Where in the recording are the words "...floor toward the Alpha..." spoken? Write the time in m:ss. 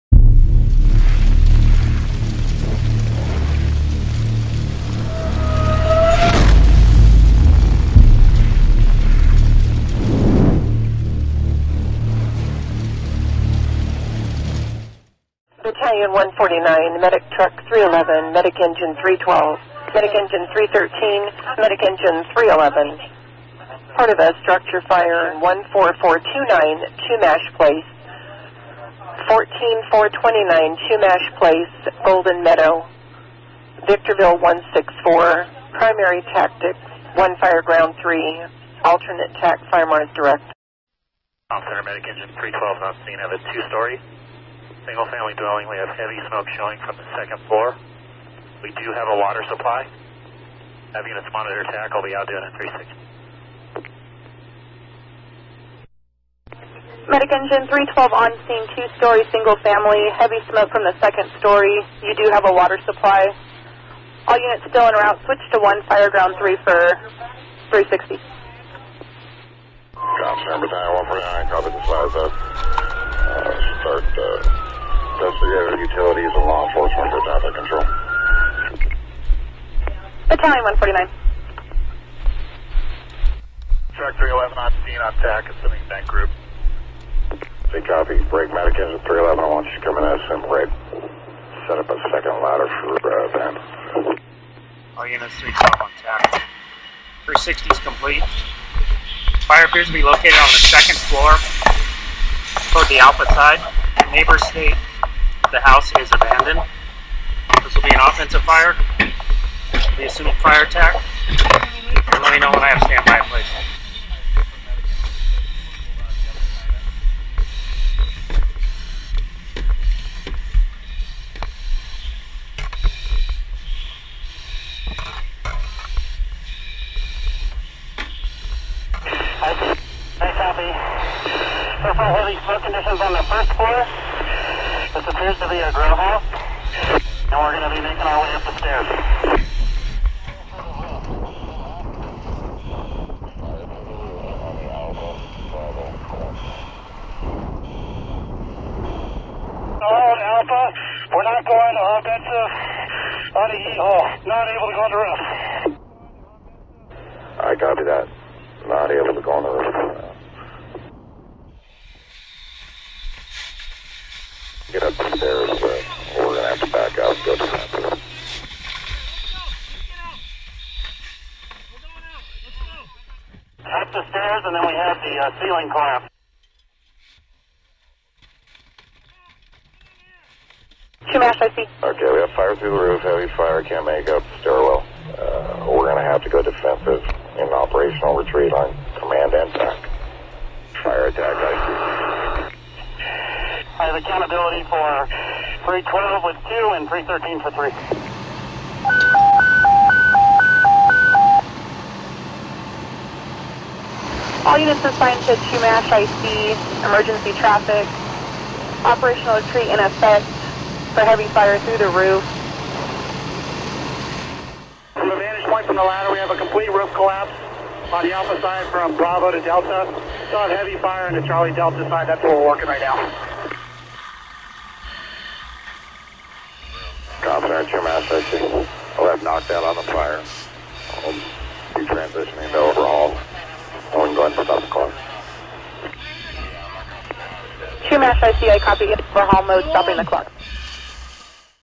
1:41.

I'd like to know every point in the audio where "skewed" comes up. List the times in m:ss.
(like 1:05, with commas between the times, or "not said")
not said.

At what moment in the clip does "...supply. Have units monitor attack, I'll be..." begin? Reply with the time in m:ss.
0:49.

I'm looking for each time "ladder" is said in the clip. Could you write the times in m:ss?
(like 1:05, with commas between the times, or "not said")
1:32, 3:35.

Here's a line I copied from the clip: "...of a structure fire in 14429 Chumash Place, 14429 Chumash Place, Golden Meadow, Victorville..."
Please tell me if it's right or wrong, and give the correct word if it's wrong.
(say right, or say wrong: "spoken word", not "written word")
right.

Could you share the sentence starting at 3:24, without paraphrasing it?
All units assigned to Chumash, I see emergency traffic, operational retreat in effect for heavy fire through the roof.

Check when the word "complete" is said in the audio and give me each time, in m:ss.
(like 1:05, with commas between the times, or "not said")
1:37, 3:36.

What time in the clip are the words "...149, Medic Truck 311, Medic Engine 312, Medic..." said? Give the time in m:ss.
0:16.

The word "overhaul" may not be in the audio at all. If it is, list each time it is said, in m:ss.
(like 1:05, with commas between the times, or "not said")
3:52, 3:58.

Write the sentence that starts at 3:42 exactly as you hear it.
That's what we're working right now.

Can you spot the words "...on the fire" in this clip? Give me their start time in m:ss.
3:49.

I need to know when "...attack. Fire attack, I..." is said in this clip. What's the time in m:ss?
3:09.